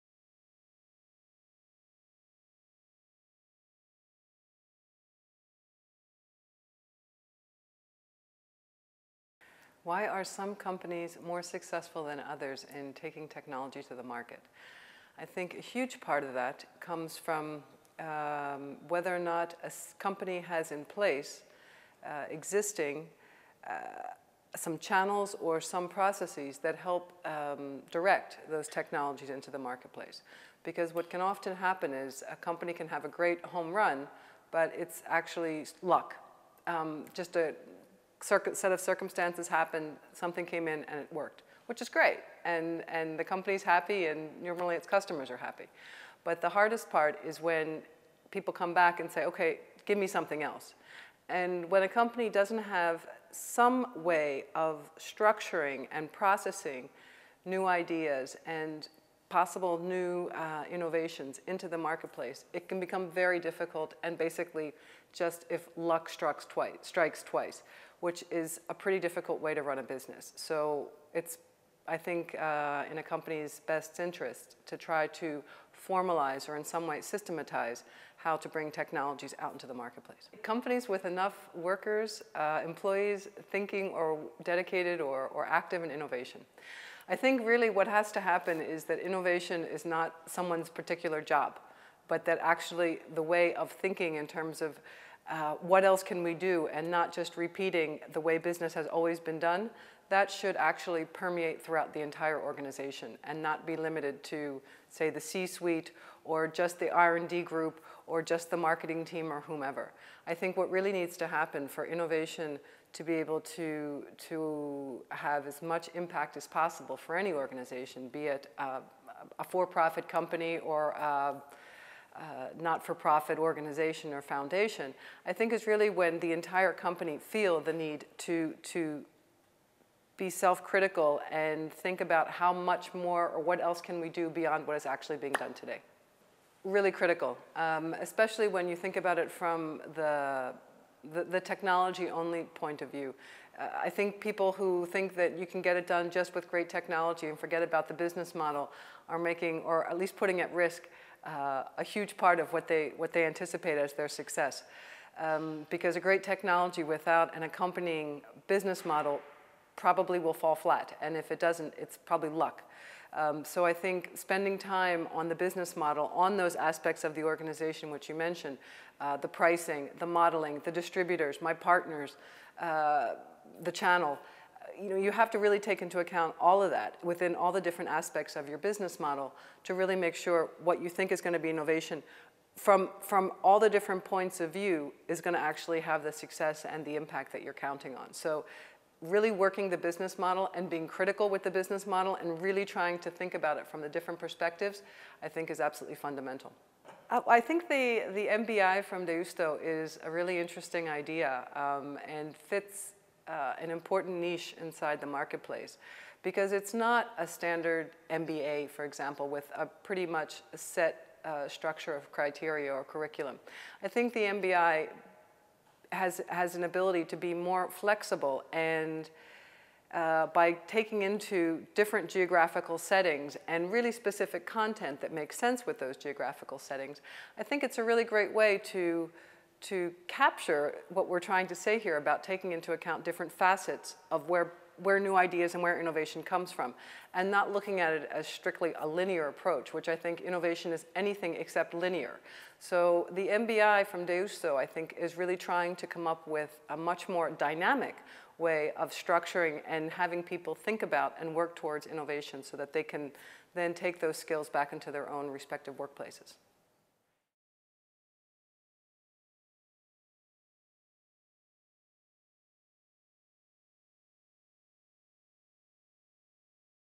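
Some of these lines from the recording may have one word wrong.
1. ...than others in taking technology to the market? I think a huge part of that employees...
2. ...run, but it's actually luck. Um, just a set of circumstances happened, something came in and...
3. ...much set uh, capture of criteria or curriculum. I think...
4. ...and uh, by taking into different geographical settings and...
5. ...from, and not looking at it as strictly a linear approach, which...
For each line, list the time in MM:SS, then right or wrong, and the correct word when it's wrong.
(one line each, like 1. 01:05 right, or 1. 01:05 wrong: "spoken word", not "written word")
1. 00:12 wrong: "comes", not "employees"
2. 00:33 right
3. 03:30 wrong: "structure", not "capture"
4. 03:38 right
5. 03:56 right.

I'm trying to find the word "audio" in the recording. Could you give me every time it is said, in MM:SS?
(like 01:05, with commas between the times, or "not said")
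not said.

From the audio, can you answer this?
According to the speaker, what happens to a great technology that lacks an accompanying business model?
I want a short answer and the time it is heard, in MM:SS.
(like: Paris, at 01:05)
Fall flat, at 02:40.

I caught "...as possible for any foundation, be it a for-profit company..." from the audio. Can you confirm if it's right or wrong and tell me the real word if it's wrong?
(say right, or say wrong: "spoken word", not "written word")
wrong: "organization", not "foundation".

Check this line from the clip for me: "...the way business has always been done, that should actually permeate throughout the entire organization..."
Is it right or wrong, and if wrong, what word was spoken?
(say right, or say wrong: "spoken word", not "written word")
right.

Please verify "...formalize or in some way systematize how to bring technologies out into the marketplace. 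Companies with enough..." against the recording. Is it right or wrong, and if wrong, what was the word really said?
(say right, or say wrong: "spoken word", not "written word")
right.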